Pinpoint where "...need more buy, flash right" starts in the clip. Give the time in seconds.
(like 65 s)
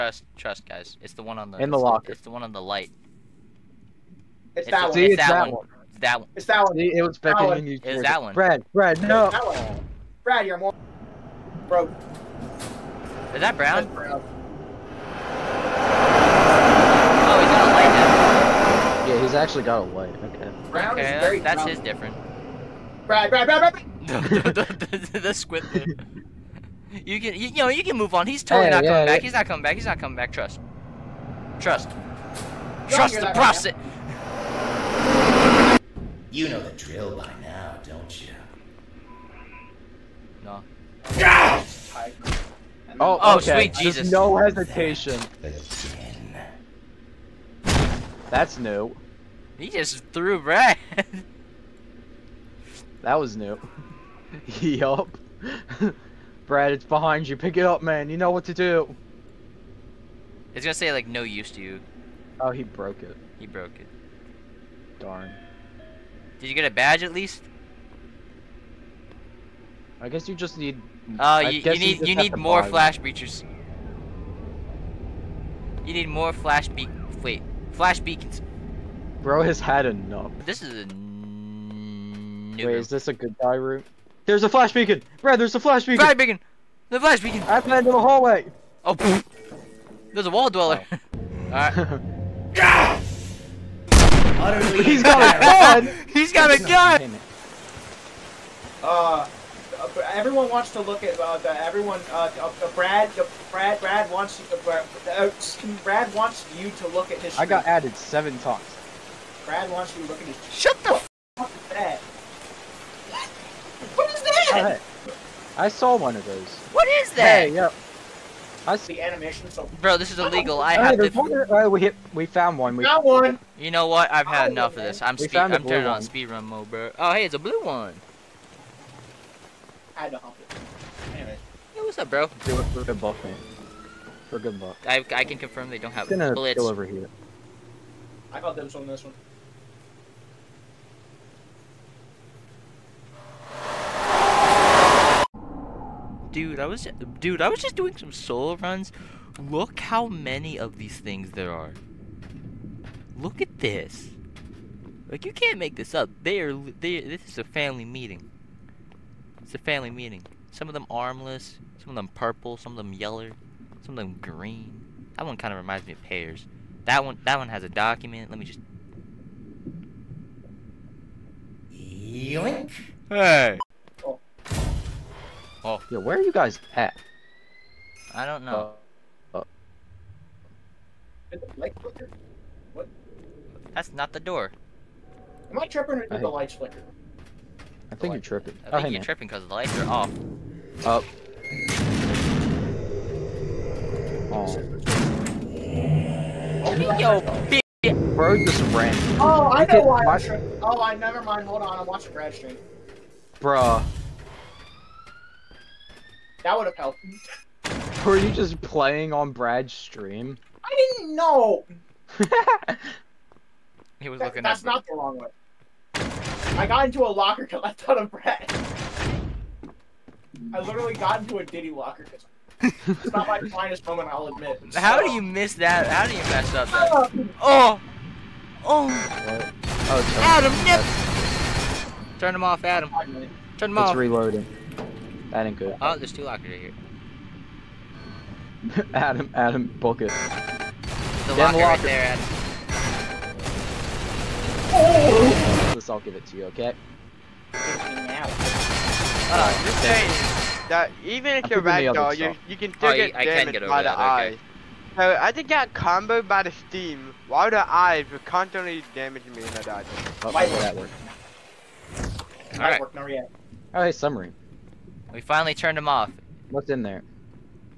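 72 s.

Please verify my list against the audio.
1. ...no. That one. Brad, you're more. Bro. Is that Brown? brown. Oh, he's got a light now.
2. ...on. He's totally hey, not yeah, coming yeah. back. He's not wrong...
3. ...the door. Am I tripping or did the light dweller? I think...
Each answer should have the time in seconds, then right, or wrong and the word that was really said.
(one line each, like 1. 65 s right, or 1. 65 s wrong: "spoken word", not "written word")
1. 9 s right
2. 28 s wrong: "coming", not "wrong"
3. 184 s wrong: "flicker", not "dweller".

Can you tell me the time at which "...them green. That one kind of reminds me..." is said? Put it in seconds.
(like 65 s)
164 s.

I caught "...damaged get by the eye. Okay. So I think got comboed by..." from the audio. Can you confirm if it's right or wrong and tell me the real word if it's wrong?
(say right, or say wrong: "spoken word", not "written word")
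right.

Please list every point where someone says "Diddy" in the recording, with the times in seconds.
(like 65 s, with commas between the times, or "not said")
221 s.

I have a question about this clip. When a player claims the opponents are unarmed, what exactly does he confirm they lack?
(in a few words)
bullets.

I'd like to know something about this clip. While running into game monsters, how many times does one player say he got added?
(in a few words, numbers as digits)
7.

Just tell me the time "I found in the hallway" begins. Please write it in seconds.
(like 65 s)
87 s.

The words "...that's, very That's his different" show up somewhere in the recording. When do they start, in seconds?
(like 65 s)
21 s.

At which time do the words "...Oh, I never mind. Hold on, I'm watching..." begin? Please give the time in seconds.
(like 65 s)
200 s.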